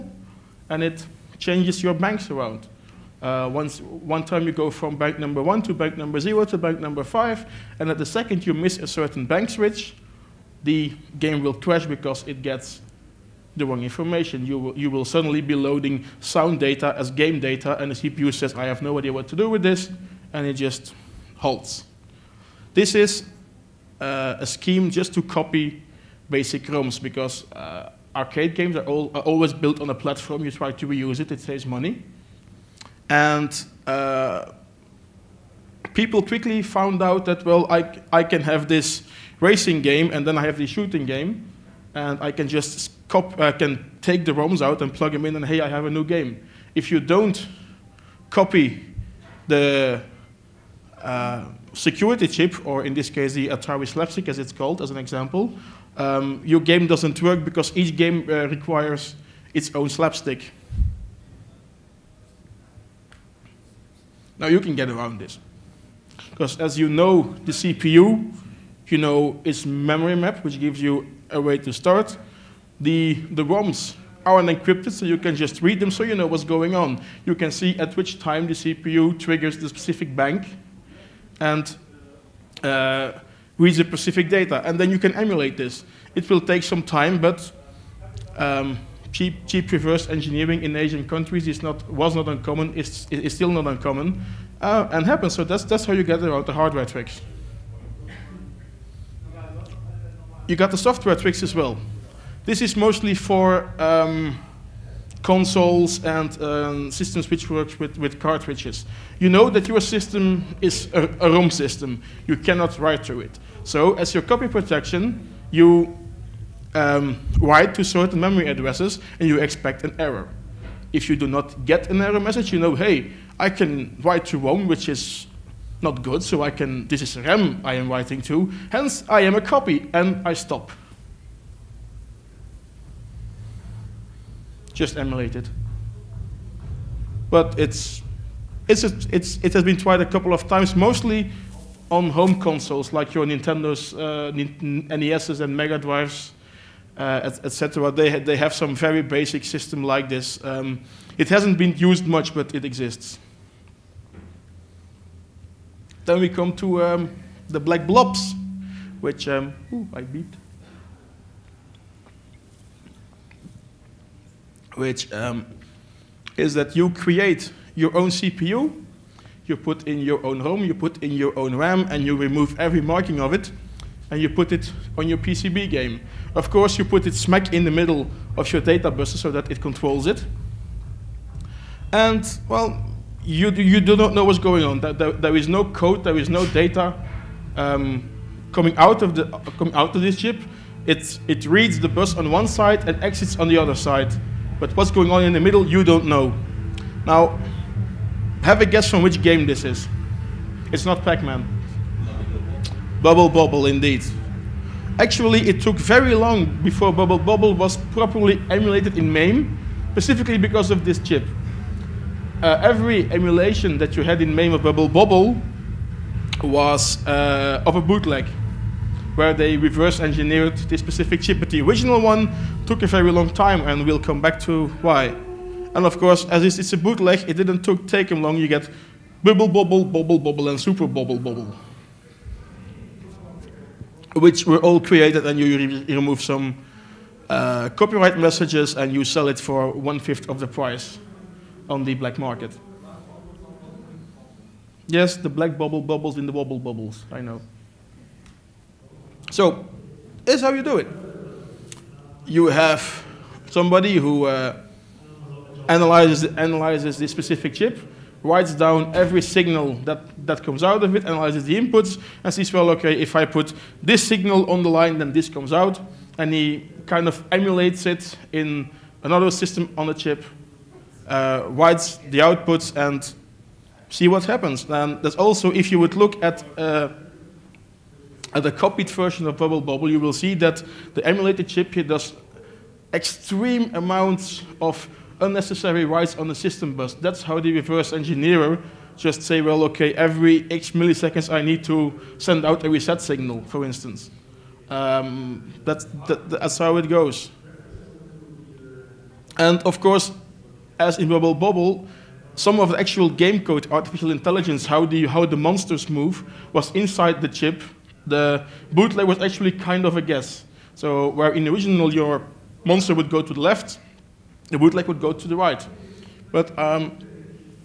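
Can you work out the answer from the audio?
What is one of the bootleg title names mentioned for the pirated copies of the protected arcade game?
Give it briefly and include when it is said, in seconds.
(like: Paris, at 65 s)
Super Bobble Bobble, at 230 s.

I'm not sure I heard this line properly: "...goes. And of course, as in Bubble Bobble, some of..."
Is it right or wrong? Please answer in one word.
right.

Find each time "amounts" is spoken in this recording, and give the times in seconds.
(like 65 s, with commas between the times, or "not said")
283 s.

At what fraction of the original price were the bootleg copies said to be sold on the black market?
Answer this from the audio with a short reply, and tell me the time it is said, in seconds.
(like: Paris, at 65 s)
one fifth, at 239 s.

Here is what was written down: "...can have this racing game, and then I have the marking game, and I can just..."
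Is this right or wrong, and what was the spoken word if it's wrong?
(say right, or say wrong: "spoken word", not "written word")
wrong: "shooting", not "marking".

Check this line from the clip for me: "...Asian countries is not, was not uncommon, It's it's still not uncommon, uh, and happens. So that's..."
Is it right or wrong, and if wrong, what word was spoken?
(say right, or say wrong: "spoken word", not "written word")
right.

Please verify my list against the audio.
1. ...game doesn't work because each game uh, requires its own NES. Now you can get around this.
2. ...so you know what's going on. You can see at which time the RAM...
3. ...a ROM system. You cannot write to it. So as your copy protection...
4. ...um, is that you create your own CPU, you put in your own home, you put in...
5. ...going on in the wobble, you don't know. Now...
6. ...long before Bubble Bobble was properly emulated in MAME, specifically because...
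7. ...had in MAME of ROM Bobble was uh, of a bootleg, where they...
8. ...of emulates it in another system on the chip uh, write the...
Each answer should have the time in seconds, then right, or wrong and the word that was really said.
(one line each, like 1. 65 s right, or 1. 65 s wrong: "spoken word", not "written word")
1. 56 s wrong: "Slapstic", not "NES"
2. 75 s wrong: "CPU", not "RAM"
3. 111 s right
4. 165 s right
5. 194 s wrong: "middle", not "wobble"
6. 206 s right
7. 214 s wrong: "Bubble", not "ROM"
8. 267 s right.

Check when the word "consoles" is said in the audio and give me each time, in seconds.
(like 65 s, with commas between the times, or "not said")
105 s, 142 s.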